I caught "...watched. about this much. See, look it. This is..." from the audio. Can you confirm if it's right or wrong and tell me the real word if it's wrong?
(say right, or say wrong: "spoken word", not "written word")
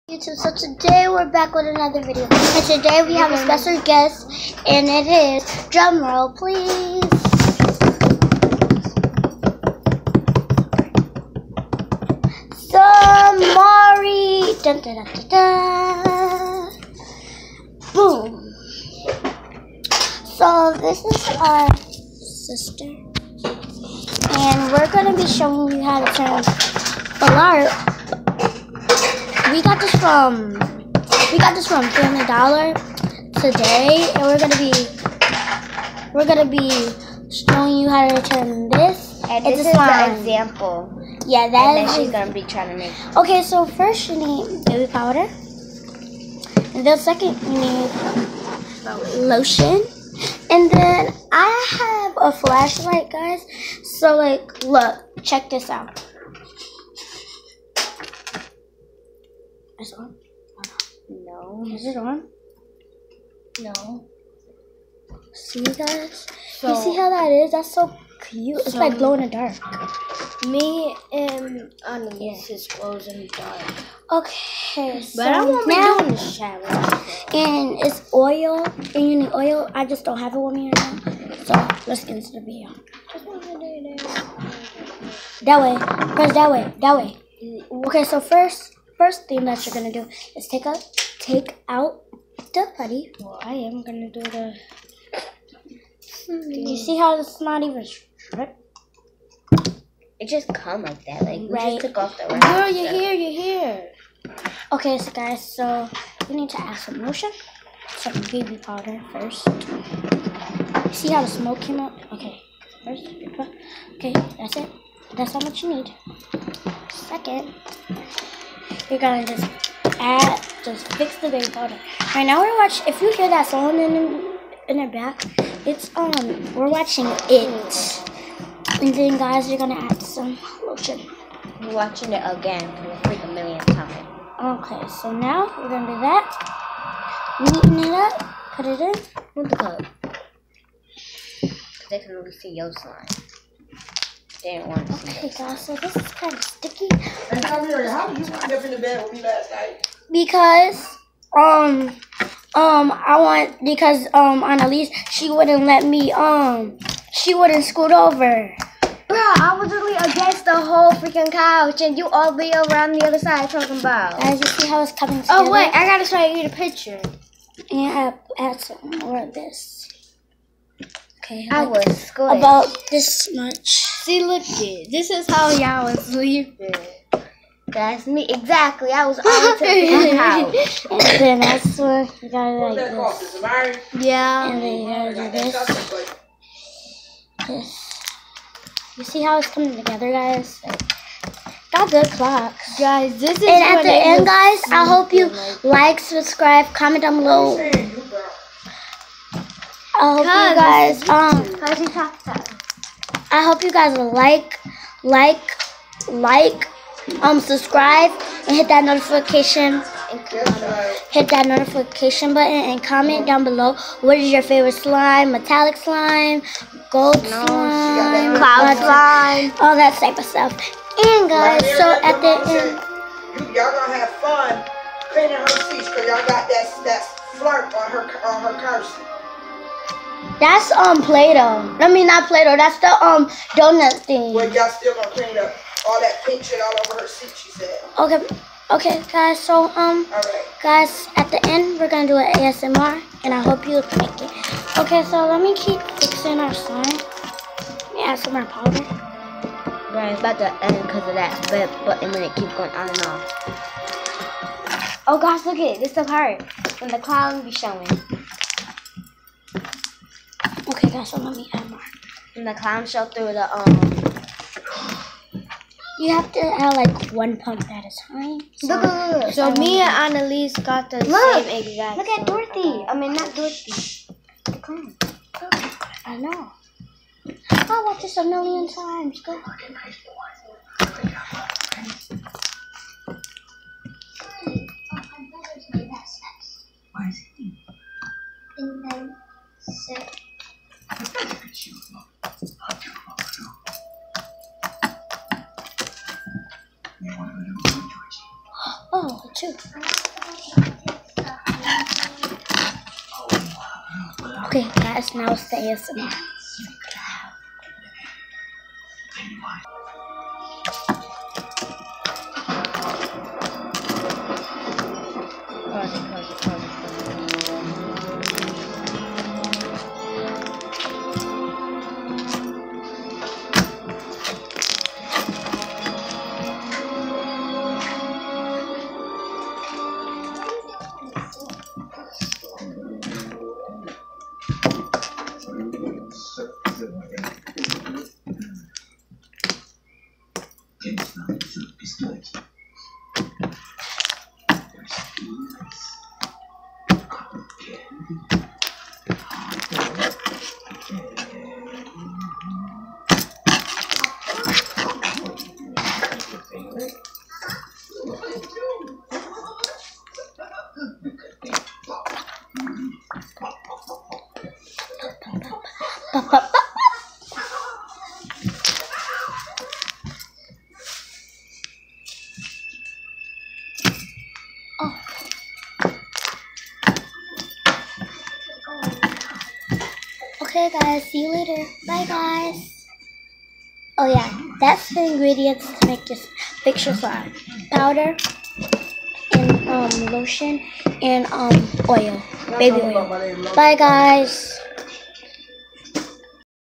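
wrong: "squished", not "watched".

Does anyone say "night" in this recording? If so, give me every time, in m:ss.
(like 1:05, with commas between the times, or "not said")
2:29.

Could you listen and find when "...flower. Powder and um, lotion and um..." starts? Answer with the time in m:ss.
6:26.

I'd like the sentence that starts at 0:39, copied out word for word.
And this, this is an example.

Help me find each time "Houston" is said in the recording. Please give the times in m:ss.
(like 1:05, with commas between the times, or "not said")
not said.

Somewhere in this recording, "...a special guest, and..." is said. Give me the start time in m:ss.
0:03.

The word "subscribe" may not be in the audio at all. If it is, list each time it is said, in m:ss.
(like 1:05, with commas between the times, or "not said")
3:16, 3:27.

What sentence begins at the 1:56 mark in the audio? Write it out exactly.
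Second, you're gonna just add, just fix the baby powder.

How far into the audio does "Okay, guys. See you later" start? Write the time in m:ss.
6:20.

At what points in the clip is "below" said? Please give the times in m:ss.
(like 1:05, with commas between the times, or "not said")
3:17, 3:33.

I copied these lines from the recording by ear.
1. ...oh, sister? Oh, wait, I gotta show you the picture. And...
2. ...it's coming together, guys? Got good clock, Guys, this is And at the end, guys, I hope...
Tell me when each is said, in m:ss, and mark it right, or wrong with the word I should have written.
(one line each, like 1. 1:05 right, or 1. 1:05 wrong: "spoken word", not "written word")
1. 2:45 wrong: "together", not "sister"
2. 3:09 right.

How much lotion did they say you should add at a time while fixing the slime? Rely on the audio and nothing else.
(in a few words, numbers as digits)
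one pump.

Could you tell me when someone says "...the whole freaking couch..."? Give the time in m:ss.
2:40.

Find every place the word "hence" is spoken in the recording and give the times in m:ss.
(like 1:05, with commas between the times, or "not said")
not said.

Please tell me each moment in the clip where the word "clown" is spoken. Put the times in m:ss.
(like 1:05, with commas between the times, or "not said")
4:16, 4:22, 4:34.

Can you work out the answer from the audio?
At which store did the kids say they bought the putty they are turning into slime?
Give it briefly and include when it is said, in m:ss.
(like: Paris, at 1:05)
Family Dollar, at 0:31.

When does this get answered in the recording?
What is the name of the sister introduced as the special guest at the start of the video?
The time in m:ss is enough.
0:12.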